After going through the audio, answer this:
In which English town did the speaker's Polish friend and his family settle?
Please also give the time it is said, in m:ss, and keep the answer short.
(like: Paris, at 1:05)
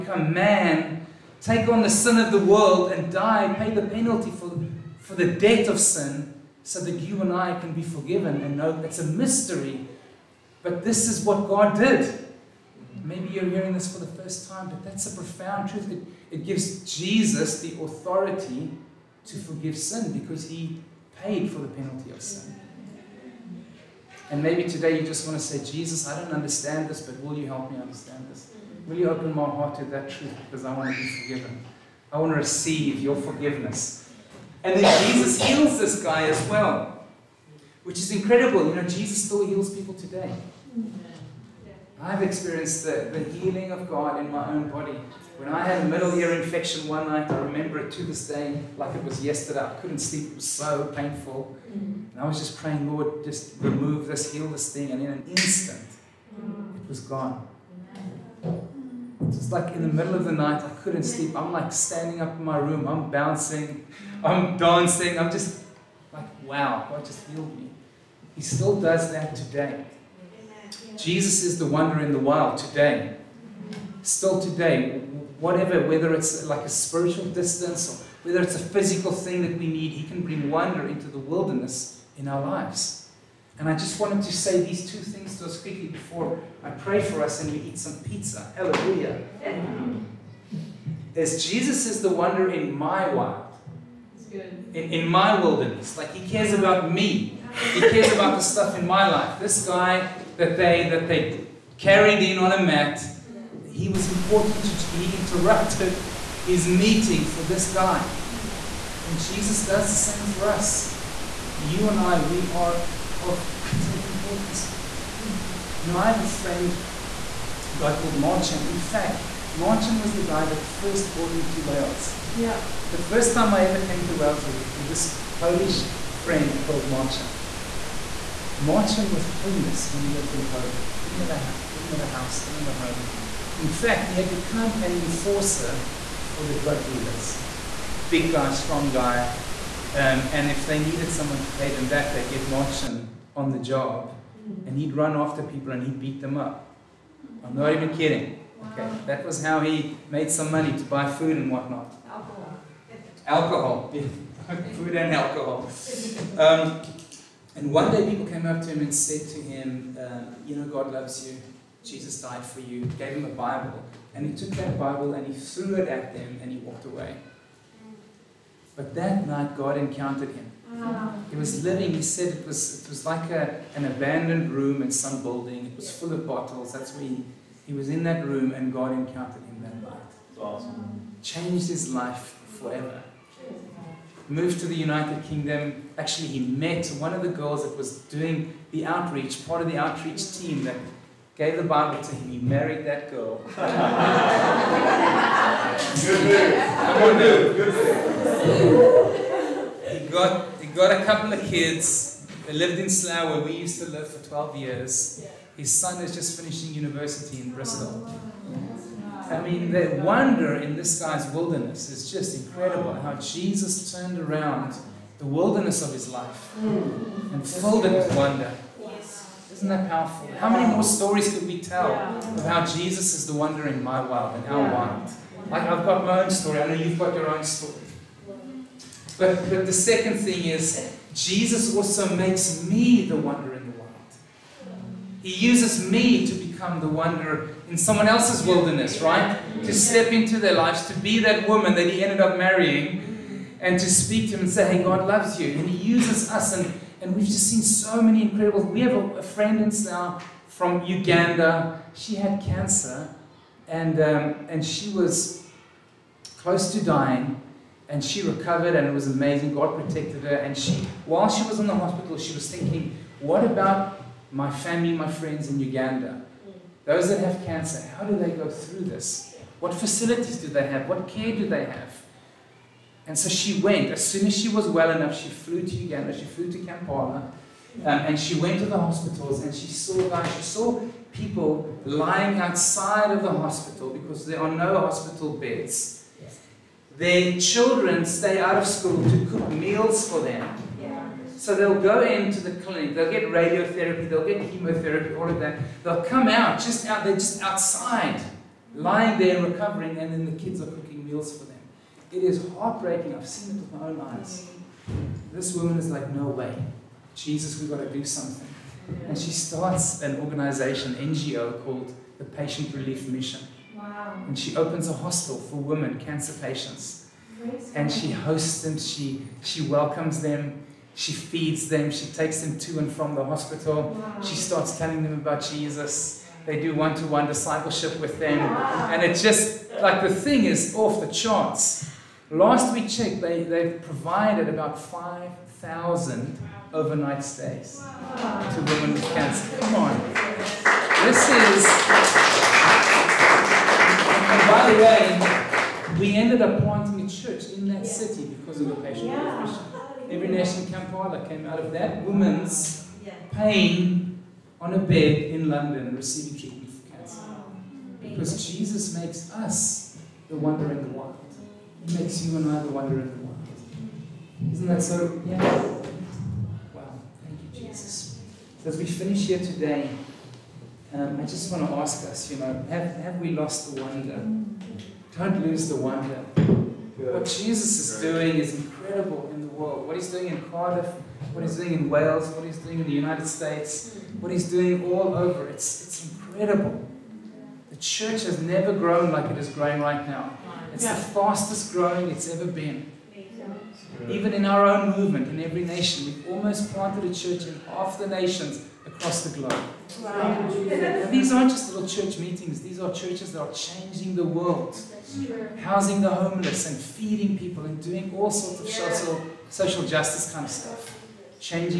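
Slough, at 3:22.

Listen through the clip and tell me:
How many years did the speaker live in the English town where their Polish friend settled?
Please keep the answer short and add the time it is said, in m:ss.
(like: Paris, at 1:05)
12 years, at 3:24.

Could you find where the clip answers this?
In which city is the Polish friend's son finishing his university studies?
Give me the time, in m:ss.
3:27.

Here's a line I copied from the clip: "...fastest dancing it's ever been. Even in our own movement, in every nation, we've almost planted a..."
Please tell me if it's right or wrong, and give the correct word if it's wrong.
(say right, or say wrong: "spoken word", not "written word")
wrong: "growing", not "dancing".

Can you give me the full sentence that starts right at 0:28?
Will you open my heart to that truth because I want to be forgiven?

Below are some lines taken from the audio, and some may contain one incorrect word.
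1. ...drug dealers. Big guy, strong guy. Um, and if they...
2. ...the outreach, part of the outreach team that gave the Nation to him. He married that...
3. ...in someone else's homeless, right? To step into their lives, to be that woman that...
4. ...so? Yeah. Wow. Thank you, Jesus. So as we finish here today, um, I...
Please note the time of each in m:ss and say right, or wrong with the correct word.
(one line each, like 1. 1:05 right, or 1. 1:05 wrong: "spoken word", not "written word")
1. 2:16 right
2. 3:08 wrong: "Bible", not "Nation"
3. 3:57 wrong: "wilderness", not "homeless"
4. 6:04 right.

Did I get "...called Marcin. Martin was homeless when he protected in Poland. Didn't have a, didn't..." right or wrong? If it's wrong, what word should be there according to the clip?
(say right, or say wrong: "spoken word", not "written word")
wrong: "lived", not "protected".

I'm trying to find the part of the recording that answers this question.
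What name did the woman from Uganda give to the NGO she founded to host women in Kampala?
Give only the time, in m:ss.
5:12.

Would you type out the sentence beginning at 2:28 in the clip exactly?
Okay, that was how he made some money to buy food and whatnot.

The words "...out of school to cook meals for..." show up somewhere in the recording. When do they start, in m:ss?
4:48.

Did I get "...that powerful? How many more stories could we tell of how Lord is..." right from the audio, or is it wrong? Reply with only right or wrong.
wrong.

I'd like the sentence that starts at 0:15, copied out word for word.
It, it gives Jesus the authority to forgive sin because he paid for the penalty of sin.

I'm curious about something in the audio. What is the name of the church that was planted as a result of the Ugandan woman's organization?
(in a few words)
Every Nation Kampala.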